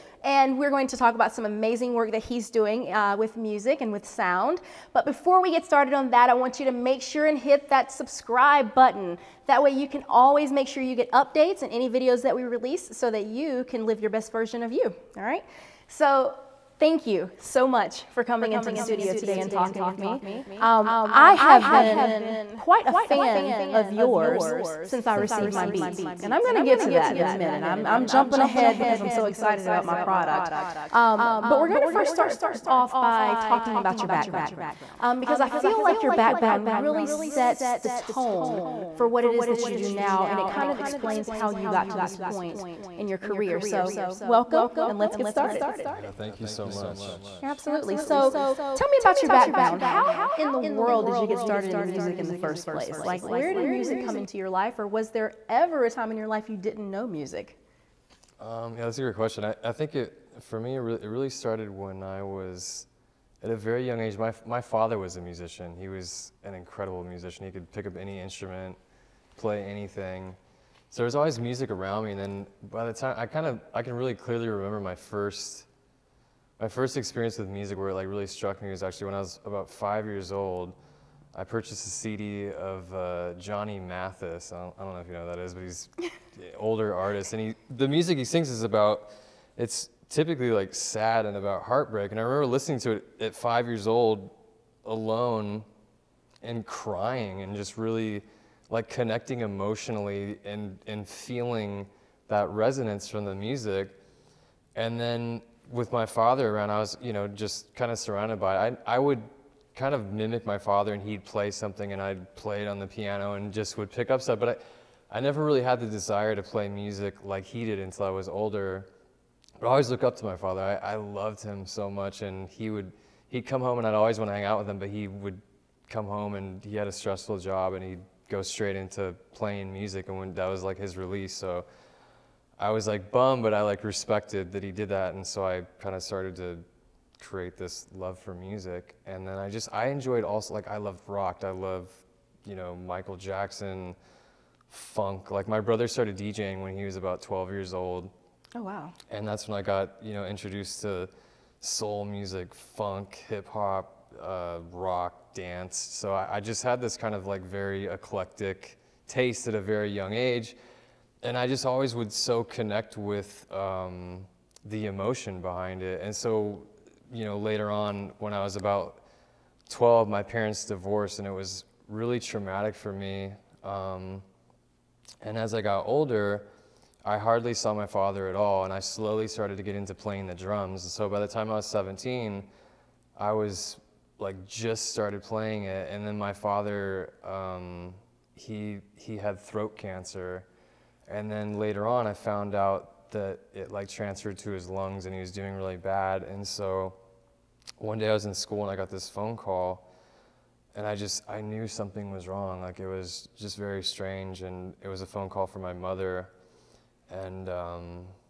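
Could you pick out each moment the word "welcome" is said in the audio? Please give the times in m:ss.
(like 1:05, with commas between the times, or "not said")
0:44.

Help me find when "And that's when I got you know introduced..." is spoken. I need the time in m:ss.
2:29.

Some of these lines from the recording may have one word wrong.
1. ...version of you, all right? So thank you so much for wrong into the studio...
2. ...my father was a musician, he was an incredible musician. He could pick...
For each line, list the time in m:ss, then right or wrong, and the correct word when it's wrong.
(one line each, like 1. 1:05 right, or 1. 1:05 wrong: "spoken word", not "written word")
1. 0:14 wrong: "coming", not "wrong"
2. 1:04 right.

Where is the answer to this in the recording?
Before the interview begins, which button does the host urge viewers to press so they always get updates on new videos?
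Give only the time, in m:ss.
0:07.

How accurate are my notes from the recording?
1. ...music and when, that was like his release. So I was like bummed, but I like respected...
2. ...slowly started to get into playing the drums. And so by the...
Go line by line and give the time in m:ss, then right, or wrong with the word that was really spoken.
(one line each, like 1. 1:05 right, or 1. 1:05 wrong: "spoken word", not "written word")
1. 2:09 right
2. 2:58 right.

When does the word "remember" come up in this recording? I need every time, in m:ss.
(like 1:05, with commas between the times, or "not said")
1:14, 1:32.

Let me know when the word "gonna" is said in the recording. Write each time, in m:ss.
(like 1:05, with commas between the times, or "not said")
0:26, 0:31.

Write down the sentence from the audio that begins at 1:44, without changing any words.
And then with my father around, I was, you know, just kind of surrounded by it.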